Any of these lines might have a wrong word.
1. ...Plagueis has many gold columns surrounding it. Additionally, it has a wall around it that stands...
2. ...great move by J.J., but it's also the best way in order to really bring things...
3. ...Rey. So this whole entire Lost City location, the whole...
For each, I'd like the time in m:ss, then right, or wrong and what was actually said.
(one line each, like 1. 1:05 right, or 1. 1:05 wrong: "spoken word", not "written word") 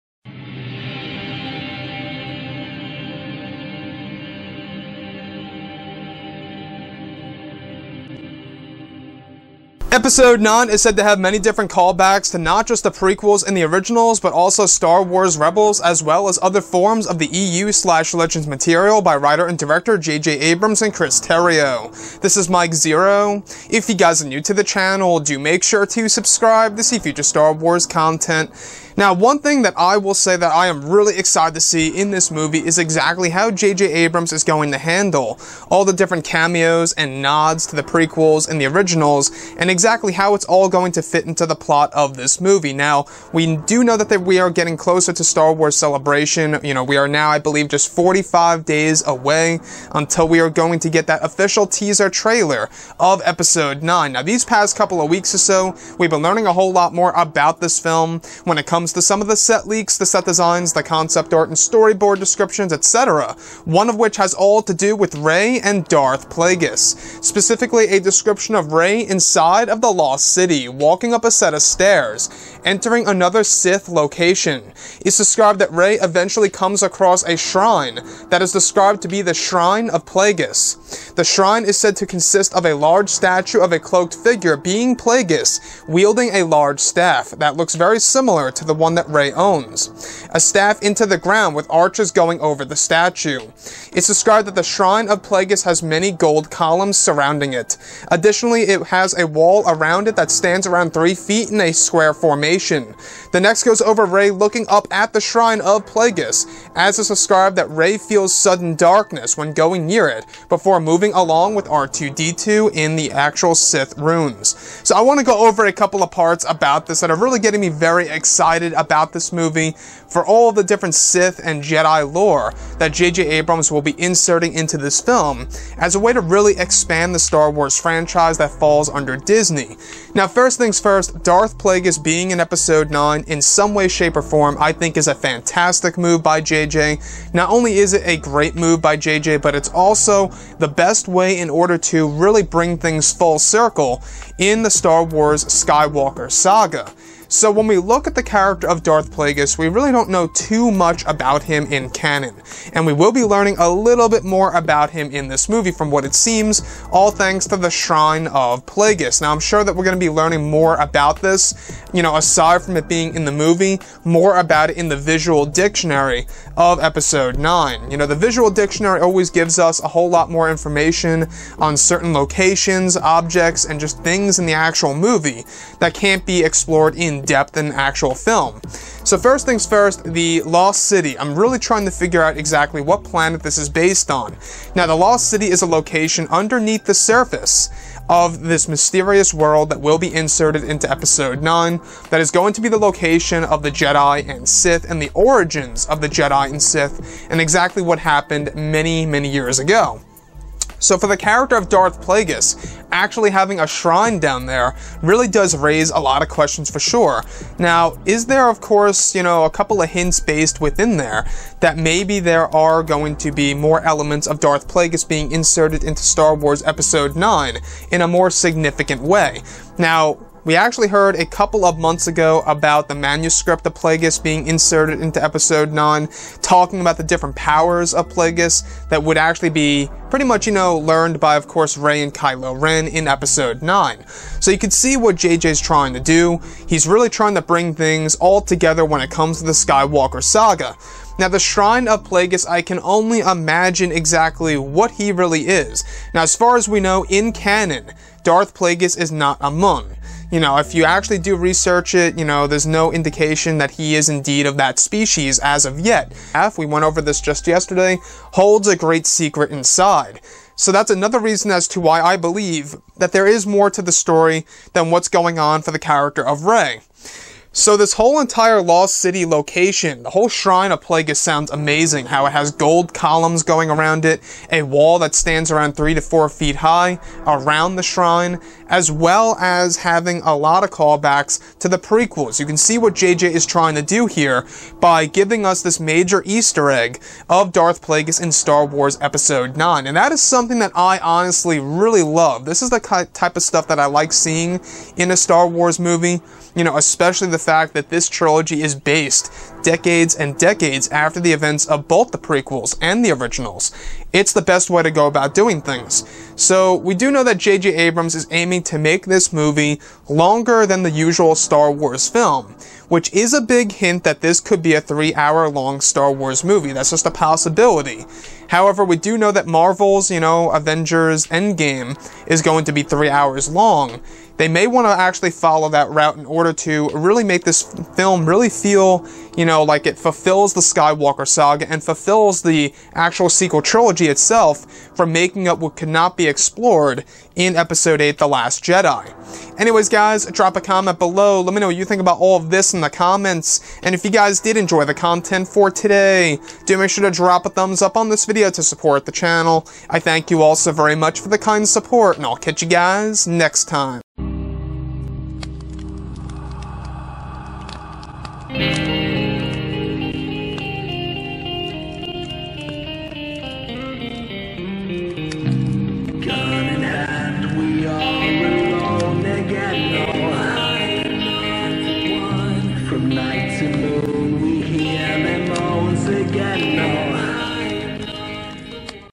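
1. 1:35 right
2. 2:18 right
3. 4:26 right.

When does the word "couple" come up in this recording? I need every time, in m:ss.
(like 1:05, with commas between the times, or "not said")
0:54, 1:55, 3:29, 3:41.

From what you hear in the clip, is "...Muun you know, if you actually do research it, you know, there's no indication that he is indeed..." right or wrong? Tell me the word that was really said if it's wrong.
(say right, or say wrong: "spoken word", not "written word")
right.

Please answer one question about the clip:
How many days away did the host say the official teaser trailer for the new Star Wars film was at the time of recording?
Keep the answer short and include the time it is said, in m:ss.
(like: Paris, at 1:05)
45, at 0:47.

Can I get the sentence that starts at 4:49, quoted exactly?
And that is something that I honestly really love.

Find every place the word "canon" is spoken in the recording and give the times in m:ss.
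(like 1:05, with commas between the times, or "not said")
2:31, 4:07.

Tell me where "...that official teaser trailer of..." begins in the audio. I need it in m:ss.
0:51.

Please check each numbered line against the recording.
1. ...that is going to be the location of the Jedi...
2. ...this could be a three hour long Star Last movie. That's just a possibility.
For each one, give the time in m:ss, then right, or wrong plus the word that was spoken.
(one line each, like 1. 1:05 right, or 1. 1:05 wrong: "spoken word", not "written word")
1. 3:12 right
2. 5:14 wrong: "Wars", not "Last".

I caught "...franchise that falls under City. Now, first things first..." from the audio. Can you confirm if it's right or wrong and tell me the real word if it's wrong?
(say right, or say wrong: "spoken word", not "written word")
wrong: "Disney", not "City".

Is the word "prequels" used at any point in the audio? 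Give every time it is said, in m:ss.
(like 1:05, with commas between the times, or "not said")
0:12, 0:37, 4:41, 5:02.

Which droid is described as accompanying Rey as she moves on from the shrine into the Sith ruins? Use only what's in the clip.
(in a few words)
R2-D2.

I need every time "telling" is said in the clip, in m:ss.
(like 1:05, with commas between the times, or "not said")
not said.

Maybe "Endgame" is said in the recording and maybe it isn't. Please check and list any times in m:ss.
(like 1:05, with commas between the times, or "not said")
5:21.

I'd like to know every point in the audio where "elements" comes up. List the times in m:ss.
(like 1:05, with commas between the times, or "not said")
3:33.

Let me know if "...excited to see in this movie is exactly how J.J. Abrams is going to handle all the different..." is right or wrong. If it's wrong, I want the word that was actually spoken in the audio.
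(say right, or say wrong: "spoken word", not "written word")
right.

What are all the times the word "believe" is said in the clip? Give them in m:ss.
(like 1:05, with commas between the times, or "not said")
0:47, 4:22.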